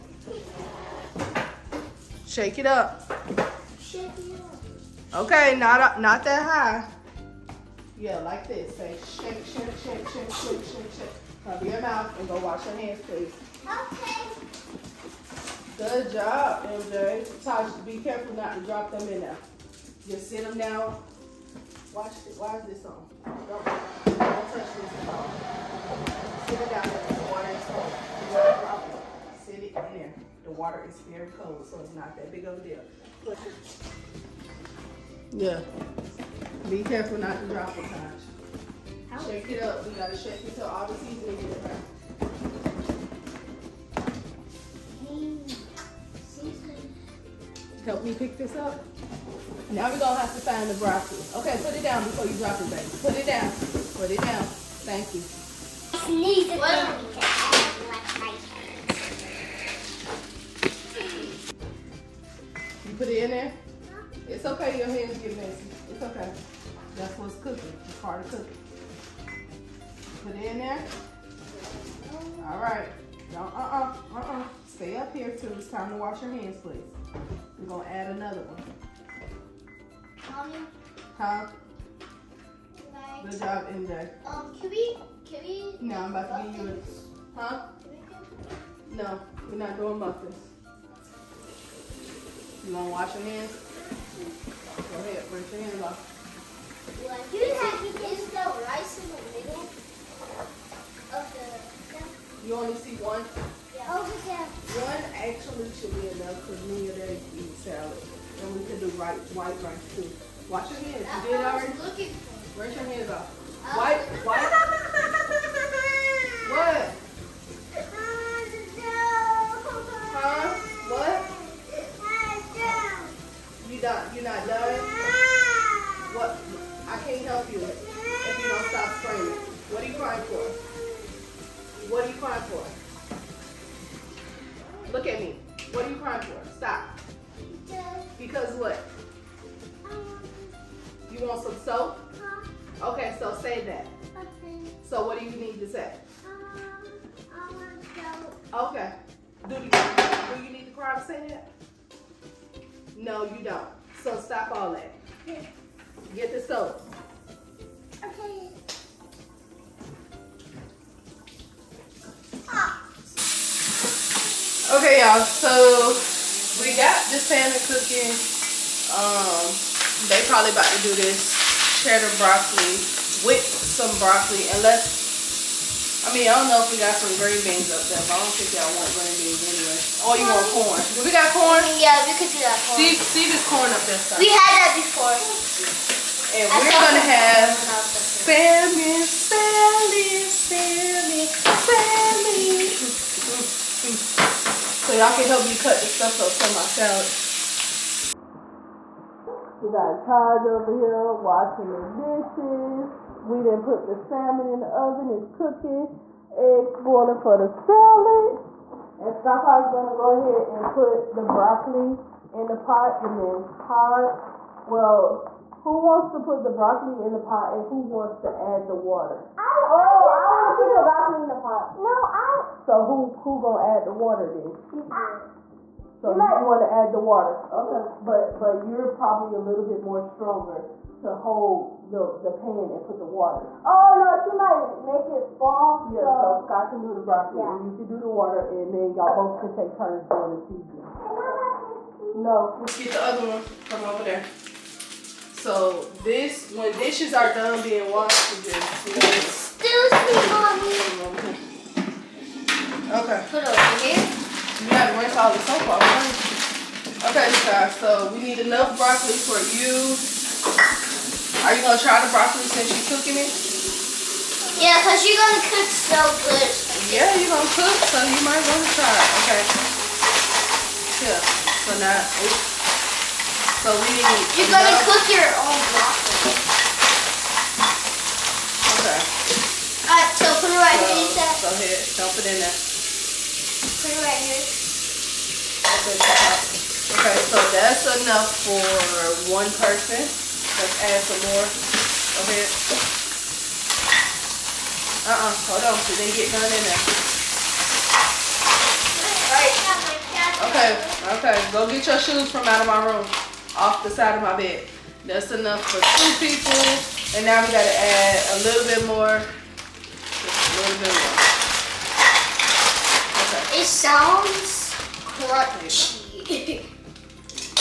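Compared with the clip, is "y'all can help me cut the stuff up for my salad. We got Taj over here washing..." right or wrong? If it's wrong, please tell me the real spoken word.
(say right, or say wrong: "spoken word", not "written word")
right.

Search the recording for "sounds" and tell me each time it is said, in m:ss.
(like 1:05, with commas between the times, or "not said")
5:13.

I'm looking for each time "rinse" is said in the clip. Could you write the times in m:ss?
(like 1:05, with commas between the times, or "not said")
1:35, 1:52, 4:14.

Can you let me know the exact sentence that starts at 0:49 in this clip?
Now we're gonna have to find the broccoli.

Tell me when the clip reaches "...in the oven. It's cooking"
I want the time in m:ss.
3:24.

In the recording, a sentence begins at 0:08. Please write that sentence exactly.
Say shake, shake, shake, shake, shake, shake, shake.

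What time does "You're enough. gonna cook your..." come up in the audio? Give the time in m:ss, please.
4:34.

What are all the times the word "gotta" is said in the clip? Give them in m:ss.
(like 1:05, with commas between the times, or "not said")
0:39, 4:14, 5:07.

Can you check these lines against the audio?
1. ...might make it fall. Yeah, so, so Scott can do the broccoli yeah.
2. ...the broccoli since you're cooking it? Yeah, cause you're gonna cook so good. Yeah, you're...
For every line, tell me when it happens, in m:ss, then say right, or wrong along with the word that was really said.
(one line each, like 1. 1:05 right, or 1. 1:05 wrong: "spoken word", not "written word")
1. 3:54 right
2. 4:22 right.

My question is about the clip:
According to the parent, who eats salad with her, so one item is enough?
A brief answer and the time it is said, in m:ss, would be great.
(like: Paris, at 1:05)
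Daddy, at 1:46.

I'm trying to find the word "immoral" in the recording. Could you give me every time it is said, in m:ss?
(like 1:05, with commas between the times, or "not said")
not said.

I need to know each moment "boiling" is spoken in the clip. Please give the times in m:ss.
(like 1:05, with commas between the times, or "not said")
3:26.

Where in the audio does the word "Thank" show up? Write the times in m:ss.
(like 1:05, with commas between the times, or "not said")
0:54.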